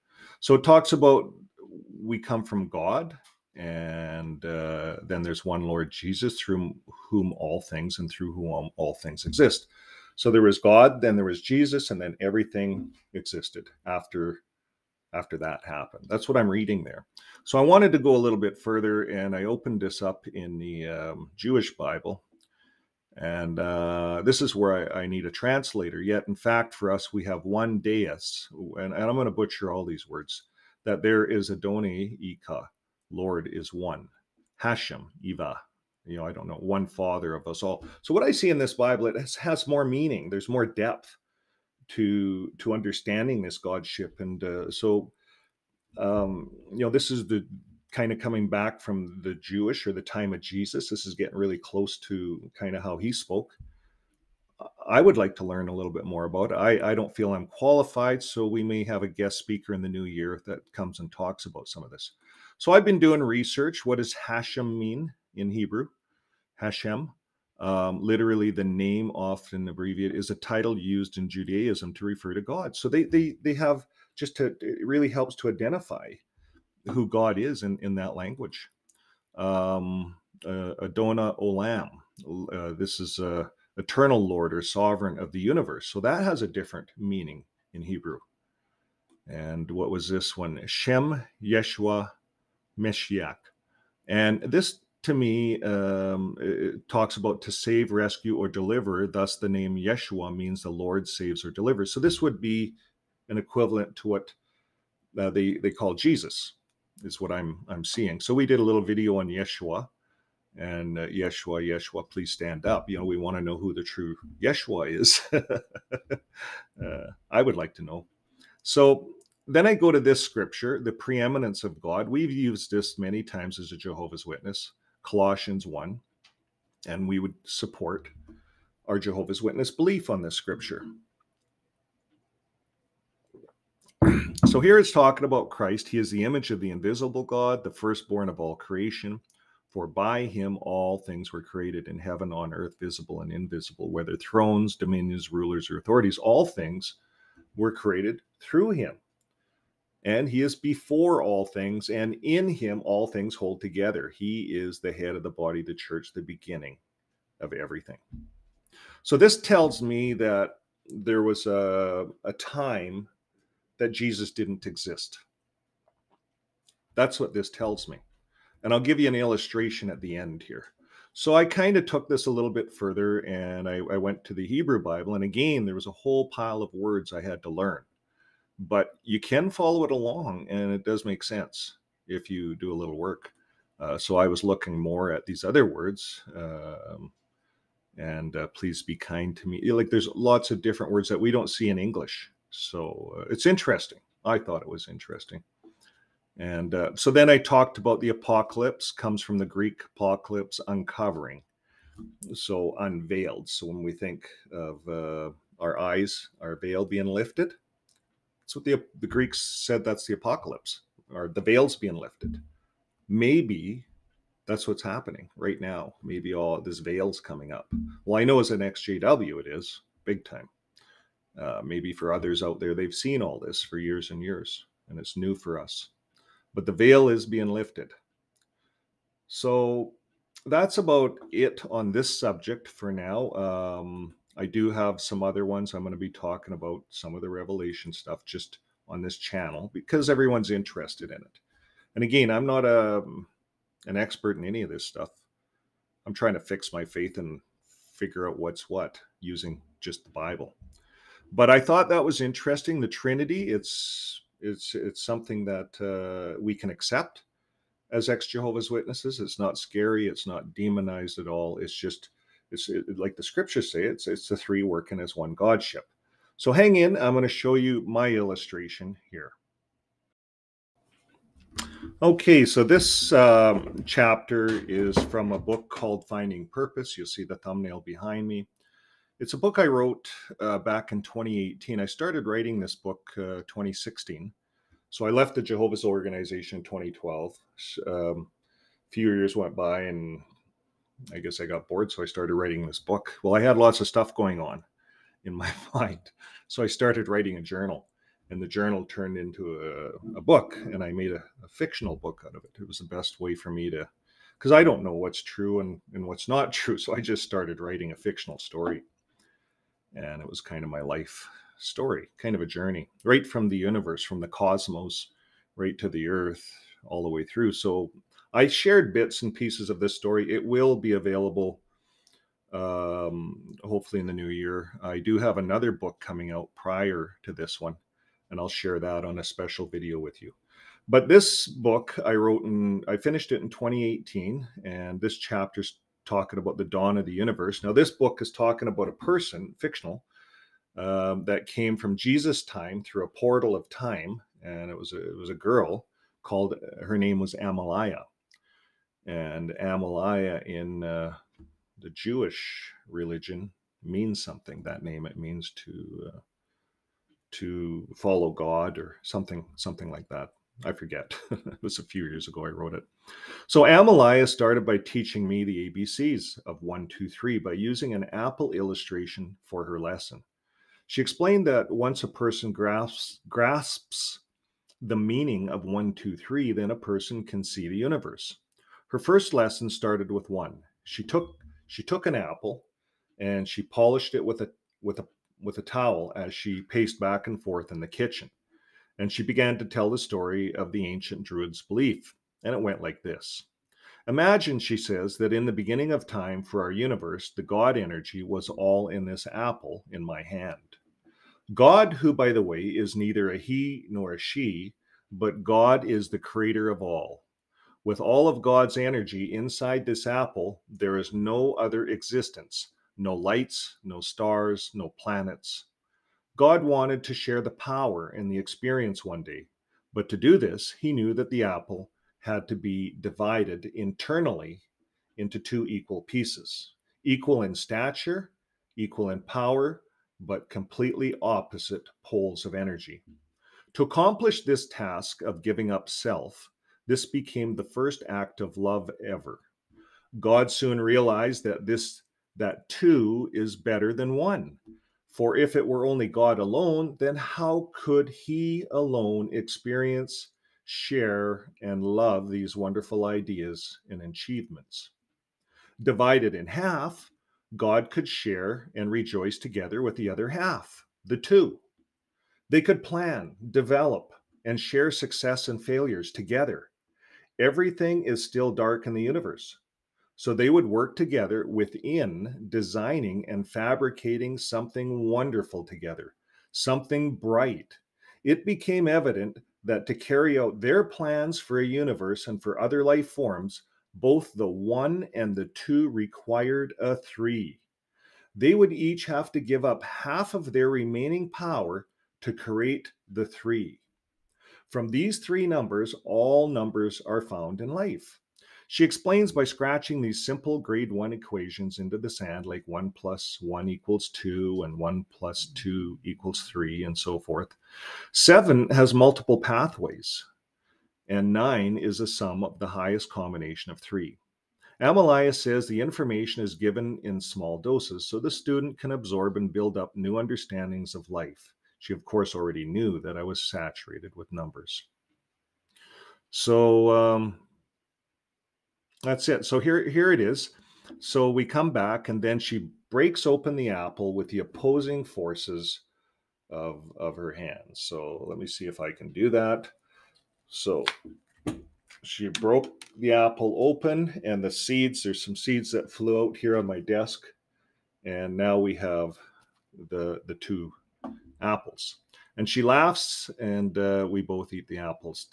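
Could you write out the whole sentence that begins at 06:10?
She explained that once a person grasps, grasps the meaning of 1, 2, 3, then a person can see the universe.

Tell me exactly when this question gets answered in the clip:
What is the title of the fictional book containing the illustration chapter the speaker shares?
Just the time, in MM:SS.
04:36.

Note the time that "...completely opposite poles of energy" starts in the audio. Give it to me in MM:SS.
07:10.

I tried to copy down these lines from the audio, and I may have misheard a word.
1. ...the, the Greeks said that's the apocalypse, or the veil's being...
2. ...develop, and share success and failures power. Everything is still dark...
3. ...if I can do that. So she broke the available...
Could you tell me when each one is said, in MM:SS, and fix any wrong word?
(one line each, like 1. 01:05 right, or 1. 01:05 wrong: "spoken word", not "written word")
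1. 03:28 right
2. 07:43 wrong: "together", not "power"
3. 08:58 wrong: "apple", not "available".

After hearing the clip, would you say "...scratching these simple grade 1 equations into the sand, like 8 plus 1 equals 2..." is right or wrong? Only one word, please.
wrong.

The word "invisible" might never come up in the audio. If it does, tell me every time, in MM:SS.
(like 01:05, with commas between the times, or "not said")
02:16, 02:23.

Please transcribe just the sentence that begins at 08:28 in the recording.
7 has multiple pathways, and 9 is a sum of the highest combination of 3.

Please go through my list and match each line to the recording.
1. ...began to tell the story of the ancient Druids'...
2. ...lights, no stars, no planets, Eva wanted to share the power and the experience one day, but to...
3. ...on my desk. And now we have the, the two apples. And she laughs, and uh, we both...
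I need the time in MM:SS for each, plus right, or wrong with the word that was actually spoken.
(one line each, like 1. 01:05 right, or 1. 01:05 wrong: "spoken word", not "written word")
1. 06:29 right
2. 06:53 wrong: "God", not "Eva"
3. 09:06 right.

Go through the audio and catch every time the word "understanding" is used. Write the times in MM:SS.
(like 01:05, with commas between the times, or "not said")
00:42, 08:40.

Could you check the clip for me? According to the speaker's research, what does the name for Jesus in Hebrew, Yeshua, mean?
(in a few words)
The Lord saves.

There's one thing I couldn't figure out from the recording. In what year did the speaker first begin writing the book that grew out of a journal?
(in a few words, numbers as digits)
2016.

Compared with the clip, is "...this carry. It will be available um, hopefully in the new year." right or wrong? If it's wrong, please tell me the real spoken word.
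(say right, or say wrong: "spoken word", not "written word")
wrong: "story", not "carry".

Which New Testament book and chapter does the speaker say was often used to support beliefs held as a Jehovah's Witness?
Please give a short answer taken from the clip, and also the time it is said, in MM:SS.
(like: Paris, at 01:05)
Colossians 1, at 02:05.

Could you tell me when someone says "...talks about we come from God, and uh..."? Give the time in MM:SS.
00:00.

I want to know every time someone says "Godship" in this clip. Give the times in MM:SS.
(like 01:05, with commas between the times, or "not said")
00:43, 04:25.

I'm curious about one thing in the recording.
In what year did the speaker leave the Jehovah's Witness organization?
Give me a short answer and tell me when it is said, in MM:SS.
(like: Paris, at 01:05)
2012, at 04:46.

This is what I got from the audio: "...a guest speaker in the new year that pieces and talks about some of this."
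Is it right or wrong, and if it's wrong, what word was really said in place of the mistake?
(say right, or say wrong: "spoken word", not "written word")
wrong: "comes", not "pieces".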